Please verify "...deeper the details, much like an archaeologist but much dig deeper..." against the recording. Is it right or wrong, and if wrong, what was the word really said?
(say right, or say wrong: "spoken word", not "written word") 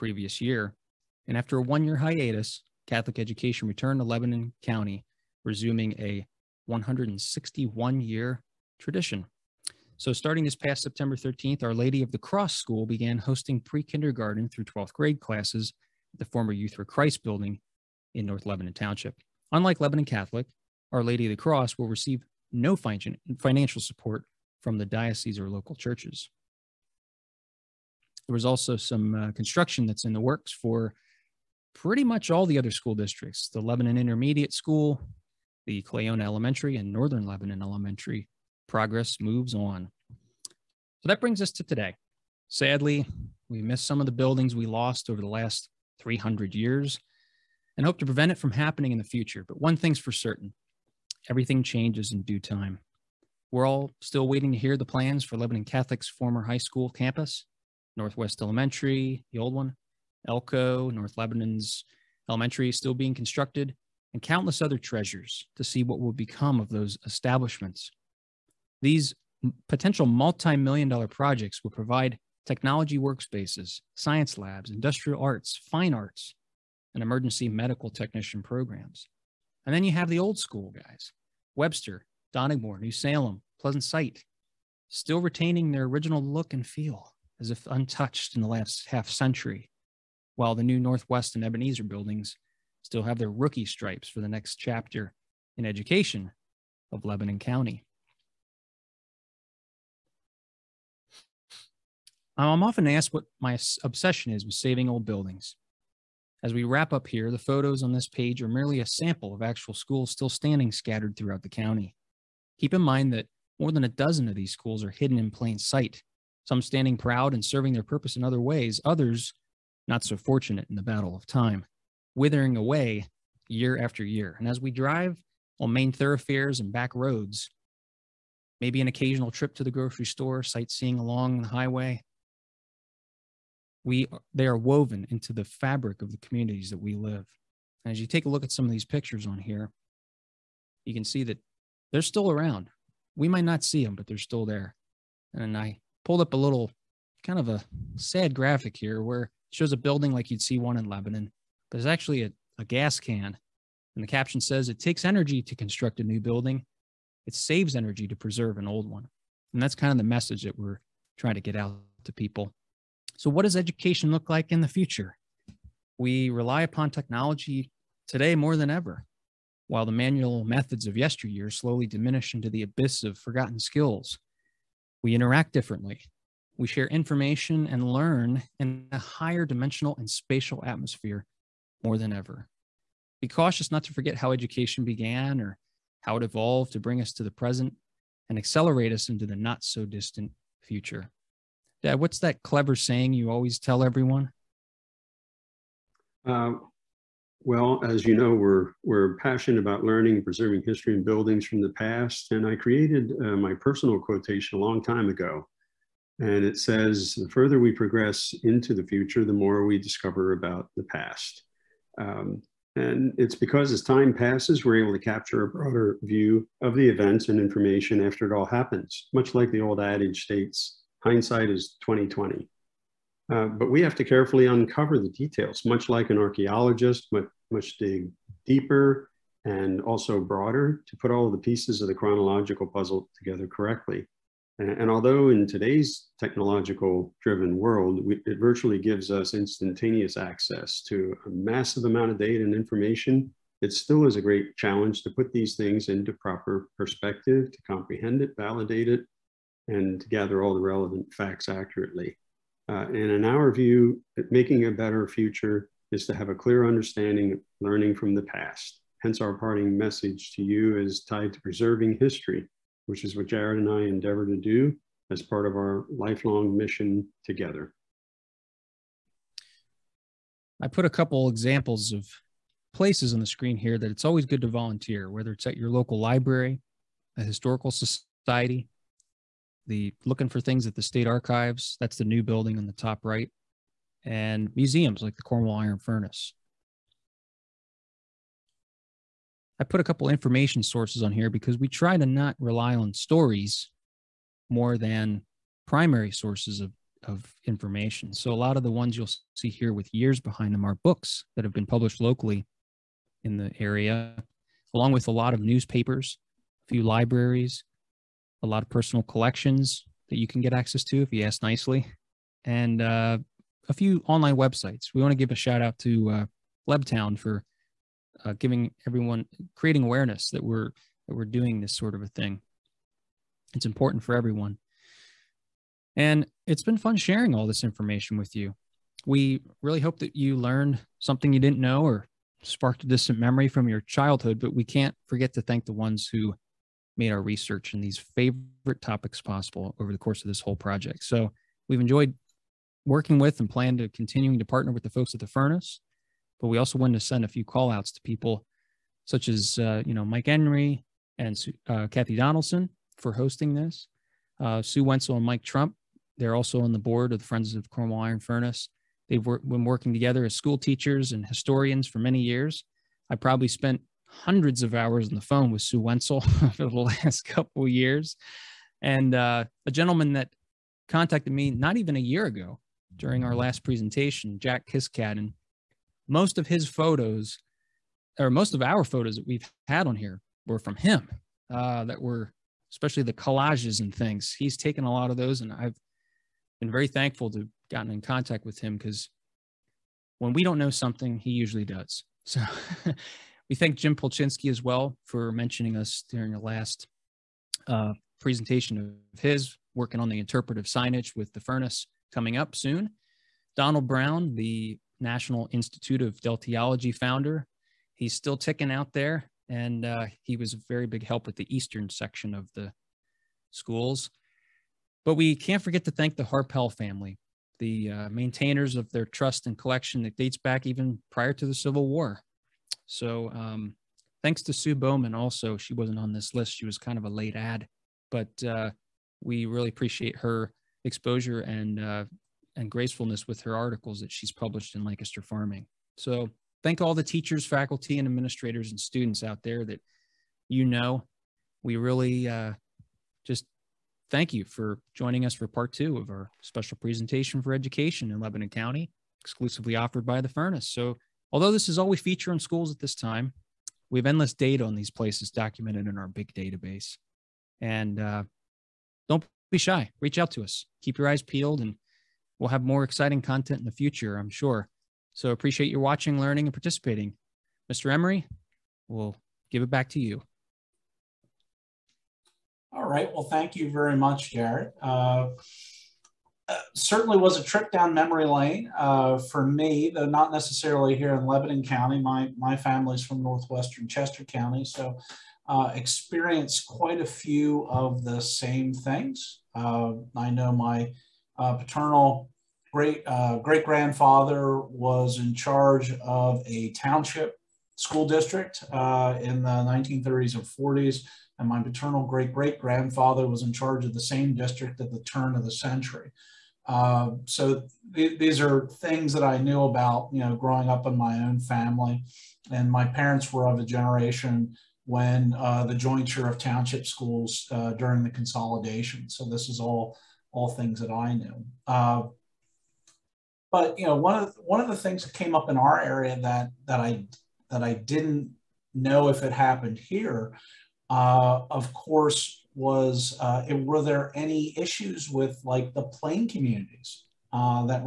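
wrong: "uncover", not "deeper".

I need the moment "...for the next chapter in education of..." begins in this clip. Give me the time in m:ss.
1:34.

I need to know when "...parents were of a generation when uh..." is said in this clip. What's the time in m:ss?
8:32.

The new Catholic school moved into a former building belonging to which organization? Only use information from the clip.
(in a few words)
Youth for Christ.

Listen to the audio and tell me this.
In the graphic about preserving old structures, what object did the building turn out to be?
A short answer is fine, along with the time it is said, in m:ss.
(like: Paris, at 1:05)
a gas can, at 2:32.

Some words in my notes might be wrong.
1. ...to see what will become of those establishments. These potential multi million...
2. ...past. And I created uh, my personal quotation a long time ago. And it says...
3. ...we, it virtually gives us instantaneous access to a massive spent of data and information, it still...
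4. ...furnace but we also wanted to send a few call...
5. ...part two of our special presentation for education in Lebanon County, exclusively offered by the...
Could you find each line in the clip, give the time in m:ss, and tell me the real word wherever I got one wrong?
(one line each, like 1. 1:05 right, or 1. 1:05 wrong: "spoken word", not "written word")
1. 1:05 right
2. 3:21 right
3. 3:58 wrong: "amount", not "spent"
4. 5:45 right
5. 7:25 right.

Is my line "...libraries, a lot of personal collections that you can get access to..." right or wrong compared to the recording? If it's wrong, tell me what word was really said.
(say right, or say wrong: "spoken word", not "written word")
right.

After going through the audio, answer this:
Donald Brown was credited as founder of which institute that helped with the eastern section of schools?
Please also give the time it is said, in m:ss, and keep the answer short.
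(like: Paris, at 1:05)
National Institute of Deltiology, at 6:44.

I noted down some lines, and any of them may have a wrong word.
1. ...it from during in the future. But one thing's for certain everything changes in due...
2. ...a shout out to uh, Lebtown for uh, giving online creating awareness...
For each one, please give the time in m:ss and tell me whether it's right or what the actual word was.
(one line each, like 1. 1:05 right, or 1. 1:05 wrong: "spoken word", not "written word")
1. 0:48 wrong: "happening", not "during"
2. 5:15 wrong: "everyone", not "online".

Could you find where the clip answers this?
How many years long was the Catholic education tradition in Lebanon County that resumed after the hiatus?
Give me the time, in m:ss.
0:06.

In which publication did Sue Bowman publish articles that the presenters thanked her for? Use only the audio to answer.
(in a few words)
Lancaster Farming.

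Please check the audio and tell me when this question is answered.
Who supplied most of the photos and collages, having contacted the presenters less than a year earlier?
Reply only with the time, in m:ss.
6:14.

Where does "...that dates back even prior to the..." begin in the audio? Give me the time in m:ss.
7:00.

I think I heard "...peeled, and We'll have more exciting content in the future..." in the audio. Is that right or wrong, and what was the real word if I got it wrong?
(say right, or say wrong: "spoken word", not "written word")
right.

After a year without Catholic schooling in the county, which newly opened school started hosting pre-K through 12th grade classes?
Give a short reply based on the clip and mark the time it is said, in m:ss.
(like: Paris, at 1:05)
Our Lady of the Cross School, at 0:11.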